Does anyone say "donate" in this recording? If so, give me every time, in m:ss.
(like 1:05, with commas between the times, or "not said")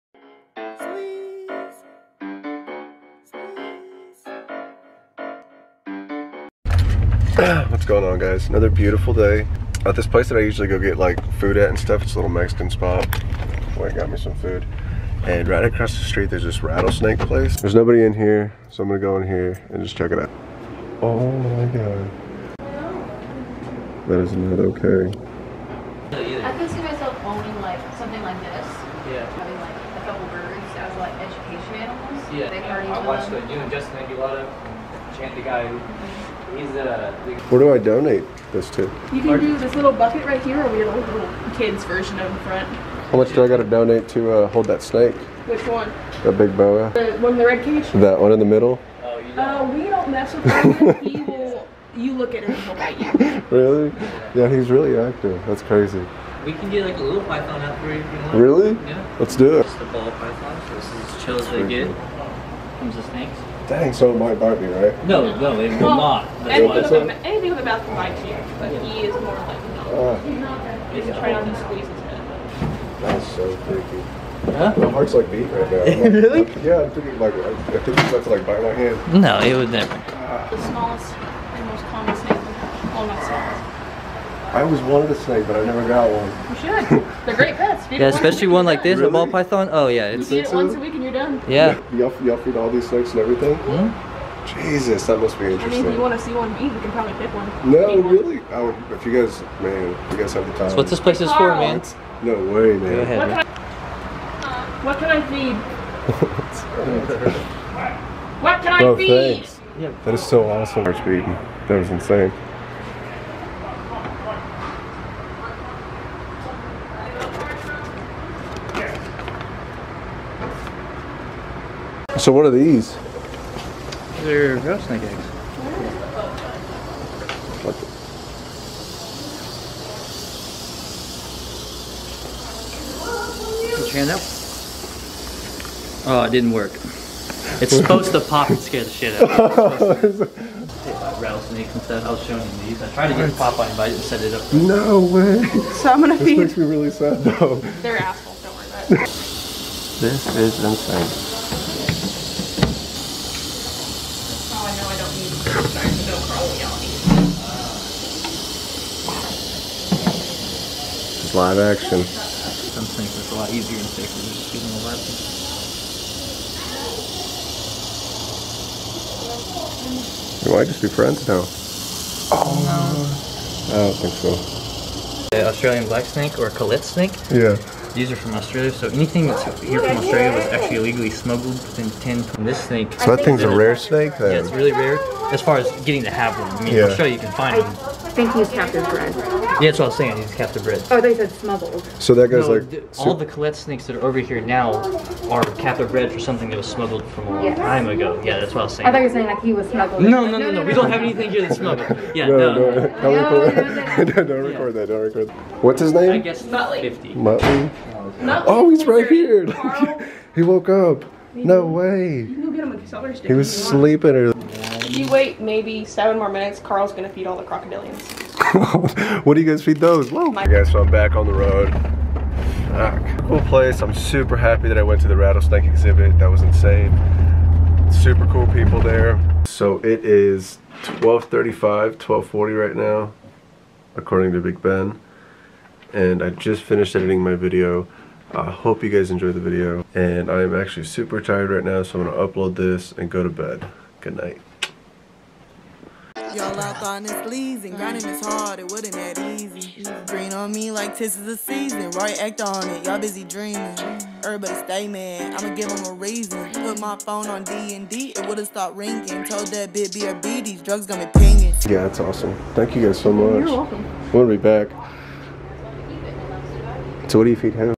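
0:37, 0:43.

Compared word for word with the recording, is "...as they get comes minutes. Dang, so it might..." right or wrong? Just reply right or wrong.
wrong.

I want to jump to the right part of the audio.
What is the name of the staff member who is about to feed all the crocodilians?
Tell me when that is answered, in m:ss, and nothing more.
3:36.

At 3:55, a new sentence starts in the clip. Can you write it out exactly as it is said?
And I just finished editing my video.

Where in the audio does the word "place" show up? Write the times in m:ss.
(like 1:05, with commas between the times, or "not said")
0:10, 0:17, 1:40, 3:43.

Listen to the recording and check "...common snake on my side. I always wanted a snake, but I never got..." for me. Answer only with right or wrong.
right.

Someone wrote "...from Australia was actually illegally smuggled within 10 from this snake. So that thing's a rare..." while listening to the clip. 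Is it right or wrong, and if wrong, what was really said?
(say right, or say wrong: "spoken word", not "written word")
right.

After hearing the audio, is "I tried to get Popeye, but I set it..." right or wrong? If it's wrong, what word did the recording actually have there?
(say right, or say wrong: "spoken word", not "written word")
right.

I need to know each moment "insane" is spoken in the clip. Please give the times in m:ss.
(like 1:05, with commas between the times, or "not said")
1:51, 2:30, 3:46.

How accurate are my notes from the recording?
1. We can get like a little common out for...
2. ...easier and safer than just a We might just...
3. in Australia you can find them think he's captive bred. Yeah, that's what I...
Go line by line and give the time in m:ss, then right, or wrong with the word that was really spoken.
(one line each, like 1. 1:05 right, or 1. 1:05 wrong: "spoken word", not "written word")
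1. 0:56 wrong: "python", not "common"
2. 2:43 right
3. 3:06 right.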